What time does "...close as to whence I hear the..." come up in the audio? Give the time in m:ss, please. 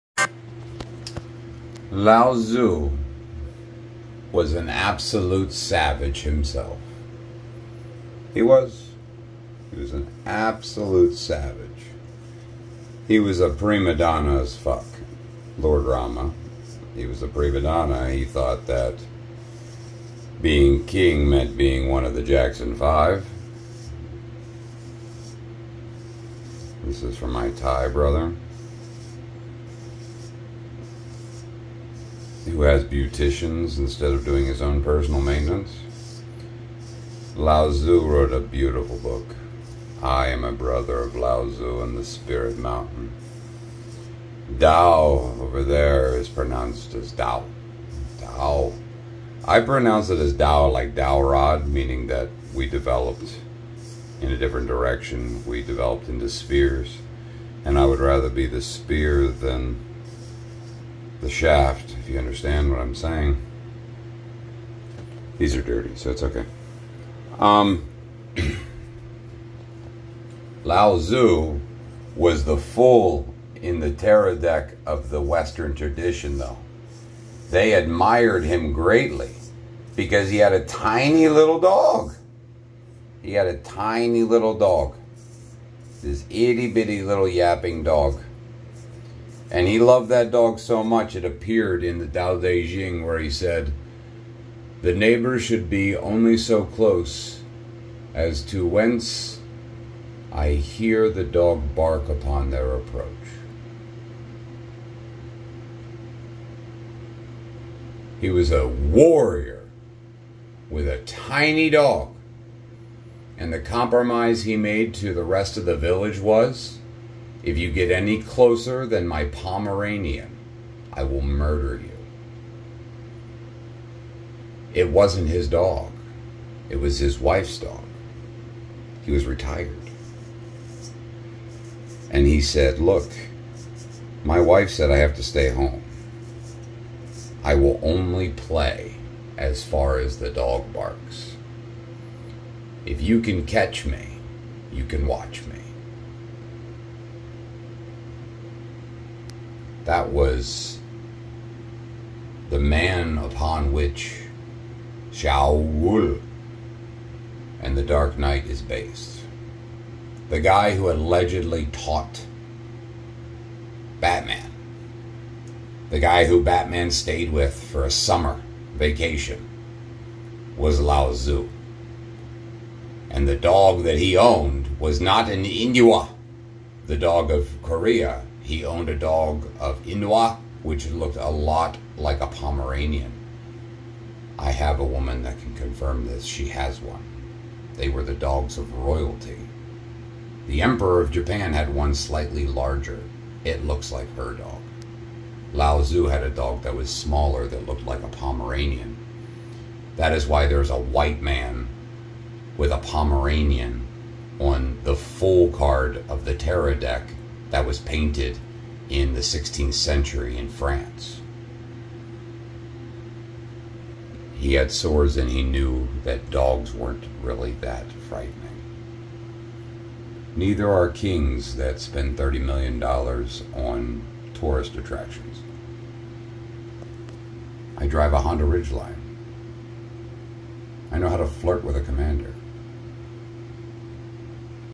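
1:36.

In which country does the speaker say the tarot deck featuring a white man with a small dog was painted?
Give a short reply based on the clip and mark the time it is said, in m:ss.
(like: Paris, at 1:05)
France, at 3:30.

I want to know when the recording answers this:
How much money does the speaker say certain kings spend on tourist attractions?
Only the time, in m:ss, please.
3:42.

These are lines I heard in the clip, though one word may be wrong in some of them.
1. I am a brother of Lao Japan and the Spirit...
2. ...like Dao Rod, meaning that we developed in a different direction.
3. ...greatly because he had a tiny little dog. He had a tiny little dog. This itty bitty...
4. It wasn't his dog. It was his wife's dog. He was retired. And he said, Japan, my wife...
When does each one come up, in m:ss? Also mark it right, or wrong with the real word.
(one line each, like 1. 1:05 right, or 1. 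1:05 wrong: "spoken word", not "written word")
1. 0:40 wrong: "Tzu", not "Japan"
2. 0:50 right
3. 1:18 right
4. 2:04 wrong: "Look", not "Japan".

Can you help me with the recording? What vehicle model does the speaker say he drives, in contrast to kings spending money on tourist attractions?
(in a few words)
Honda Ridgeline.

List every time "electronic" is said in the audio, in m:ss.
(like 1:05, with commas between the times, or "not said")
not said.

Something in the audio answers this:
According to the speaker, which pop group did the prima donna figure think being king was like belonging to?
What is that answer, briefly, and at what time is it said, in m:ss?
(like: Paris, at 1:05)
the Jackson Five, at 0:22.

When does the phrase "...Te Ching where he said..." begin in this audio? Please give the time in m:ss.
1:32.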